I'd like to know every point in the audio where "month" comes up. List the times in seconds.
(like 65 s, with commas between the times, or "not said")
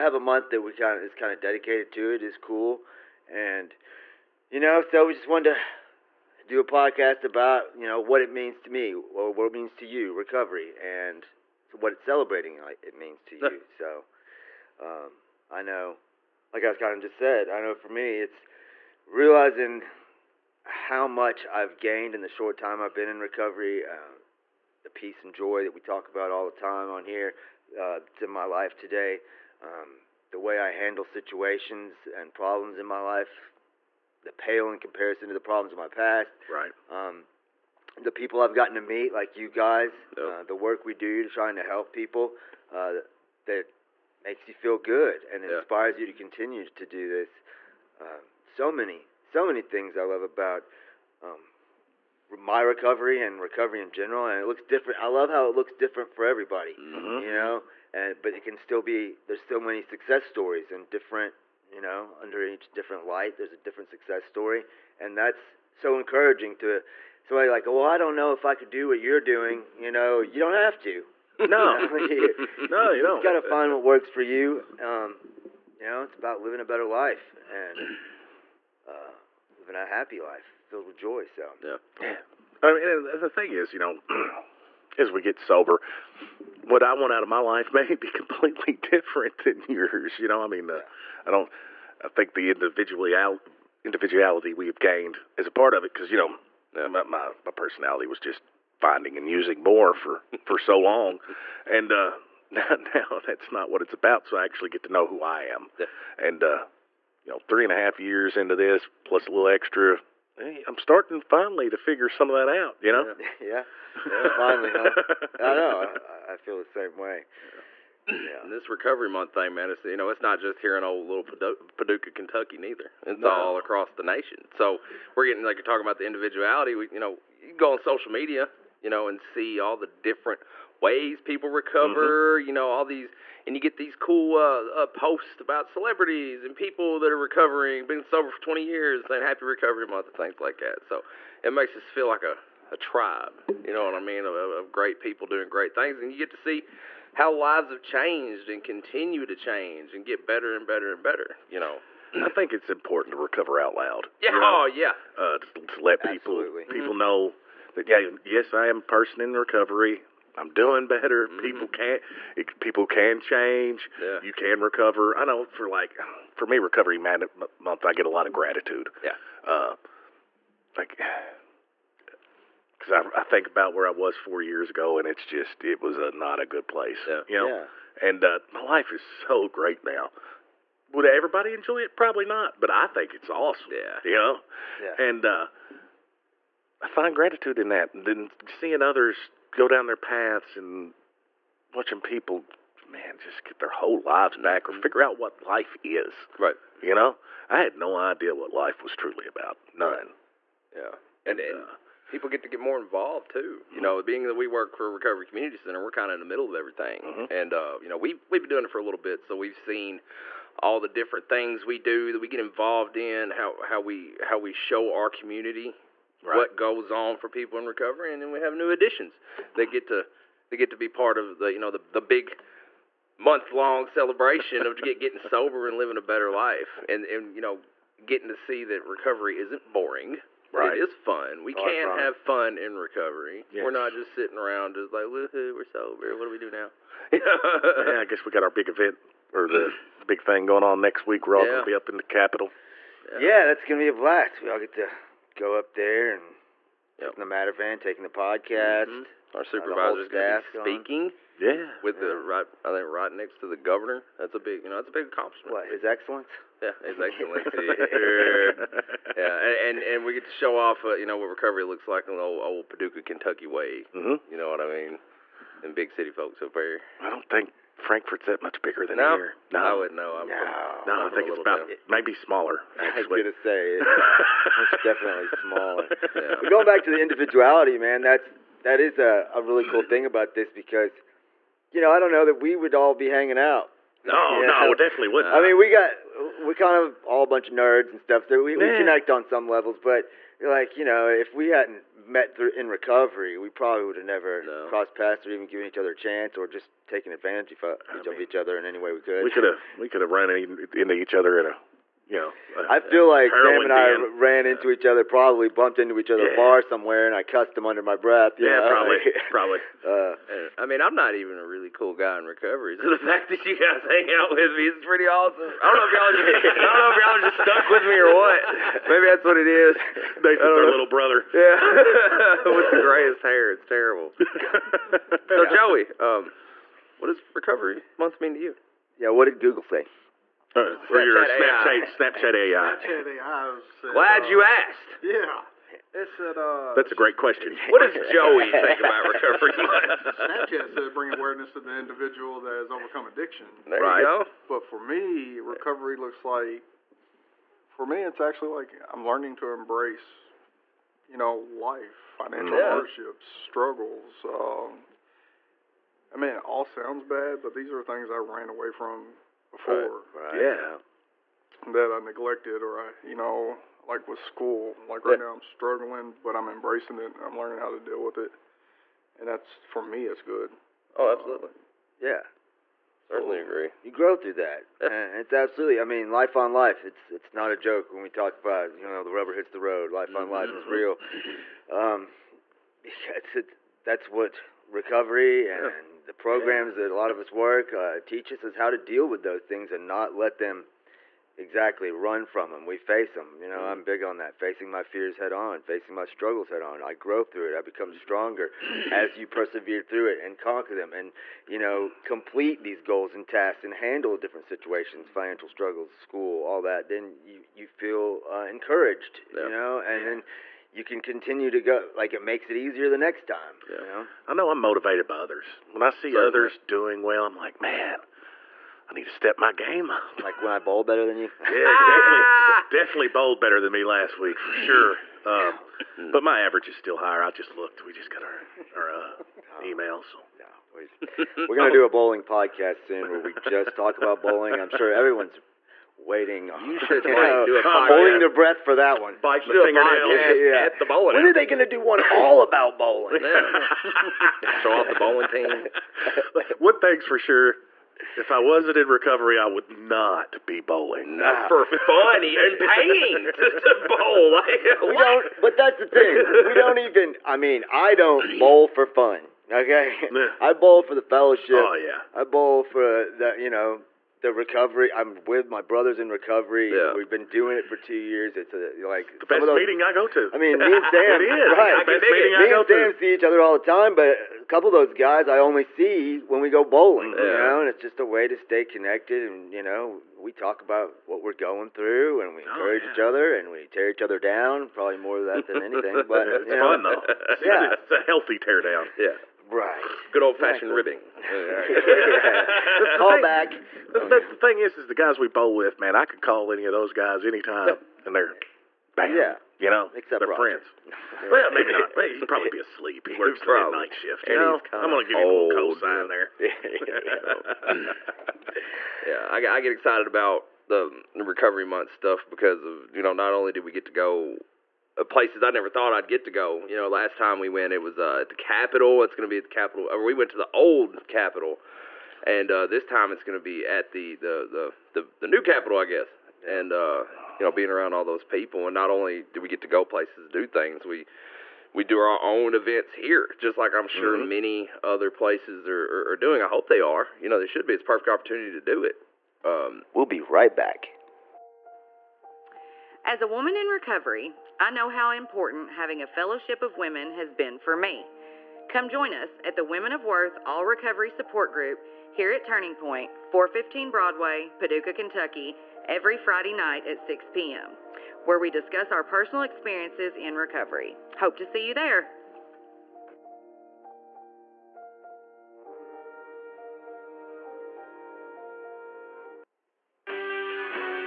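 0 s, 119 s, 139 s, 166 s, 223 s, 327 s, 511 s.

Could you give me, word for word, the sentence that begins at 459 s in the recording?
Okay, I bowl for the fellowship.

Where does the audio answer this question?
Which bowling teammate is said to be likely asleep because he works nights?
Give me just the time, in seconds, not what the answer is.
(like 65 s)
500 s.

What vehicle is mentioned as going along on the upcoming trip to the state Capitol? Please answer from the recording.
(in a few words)
the Matter Van.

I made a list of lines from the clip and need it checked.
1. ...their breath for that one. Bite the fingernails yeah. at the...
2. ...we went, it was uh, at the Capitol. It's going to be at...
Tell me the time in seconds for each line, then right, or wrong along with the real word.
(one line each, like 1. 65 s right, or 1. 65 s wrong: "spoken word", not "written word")
1. 438 s right
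2. 517 s right.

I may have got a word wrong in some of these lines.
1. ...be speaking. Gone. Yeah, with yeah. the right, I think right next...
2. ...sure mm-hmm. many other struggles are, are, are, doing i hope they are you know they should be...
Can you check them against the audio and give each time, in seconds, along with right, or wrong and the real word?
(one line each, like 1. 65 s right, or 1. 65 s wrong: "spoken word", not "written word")
1. 250 s right
2. 533 s wrong: "places", not "struggles".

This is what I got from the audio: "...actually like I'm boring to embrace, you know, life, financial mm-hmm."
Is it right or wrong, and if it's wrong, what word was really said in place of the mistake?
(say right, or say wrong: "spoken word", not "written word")
wrong: "learning", not "boring".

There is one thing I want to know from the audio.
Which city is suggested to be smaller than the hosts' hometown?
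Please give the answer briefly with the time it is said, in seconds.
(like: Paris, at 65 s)
Frankfort, at 267 s.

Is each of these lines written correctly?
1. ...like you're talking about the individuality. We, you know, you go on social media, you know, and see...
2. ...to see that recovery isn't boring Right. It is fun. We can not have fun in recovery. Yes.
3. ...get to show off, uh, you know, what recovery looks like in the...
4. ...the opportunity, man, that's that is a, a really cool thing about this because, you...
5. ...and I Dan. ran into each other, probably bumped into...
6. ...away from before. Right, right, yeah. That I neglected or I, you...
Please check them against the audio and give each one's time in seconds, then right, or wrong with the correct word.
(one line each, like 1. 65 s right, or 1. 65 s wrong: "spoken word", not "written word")
1. 125 s right
2. 228 s right
3. 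260 s right
4. 276 s wrong: "individuality", not "opportunity"
5. 303 s right
6. 358 s right.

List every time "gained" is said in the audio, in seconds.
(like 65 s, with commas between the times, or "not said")
21 s, 94 s.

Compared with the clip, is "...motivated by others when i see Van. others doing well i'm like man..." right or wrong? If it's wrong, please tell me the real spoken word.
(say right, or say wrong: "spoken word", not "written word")
wrong: "Certainly", not "Van".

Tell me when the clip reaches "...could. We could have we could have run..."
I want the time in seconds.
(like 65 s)
299 s.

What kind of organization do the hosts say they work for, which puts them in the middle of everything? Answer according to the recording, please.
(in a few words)
Recovery Community Center.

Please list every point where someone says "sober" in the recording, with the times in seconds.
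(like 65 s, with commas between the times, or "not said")
85 s, 138 s, 225 s, 235 s.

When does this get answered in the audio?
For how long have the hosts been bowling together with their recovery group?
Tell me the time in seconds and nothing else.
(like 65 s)
467 s.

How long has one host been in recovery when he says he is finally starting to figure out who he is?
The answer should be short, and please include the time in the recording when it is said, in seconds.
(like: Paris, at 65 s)
three and a half years, at 107 s.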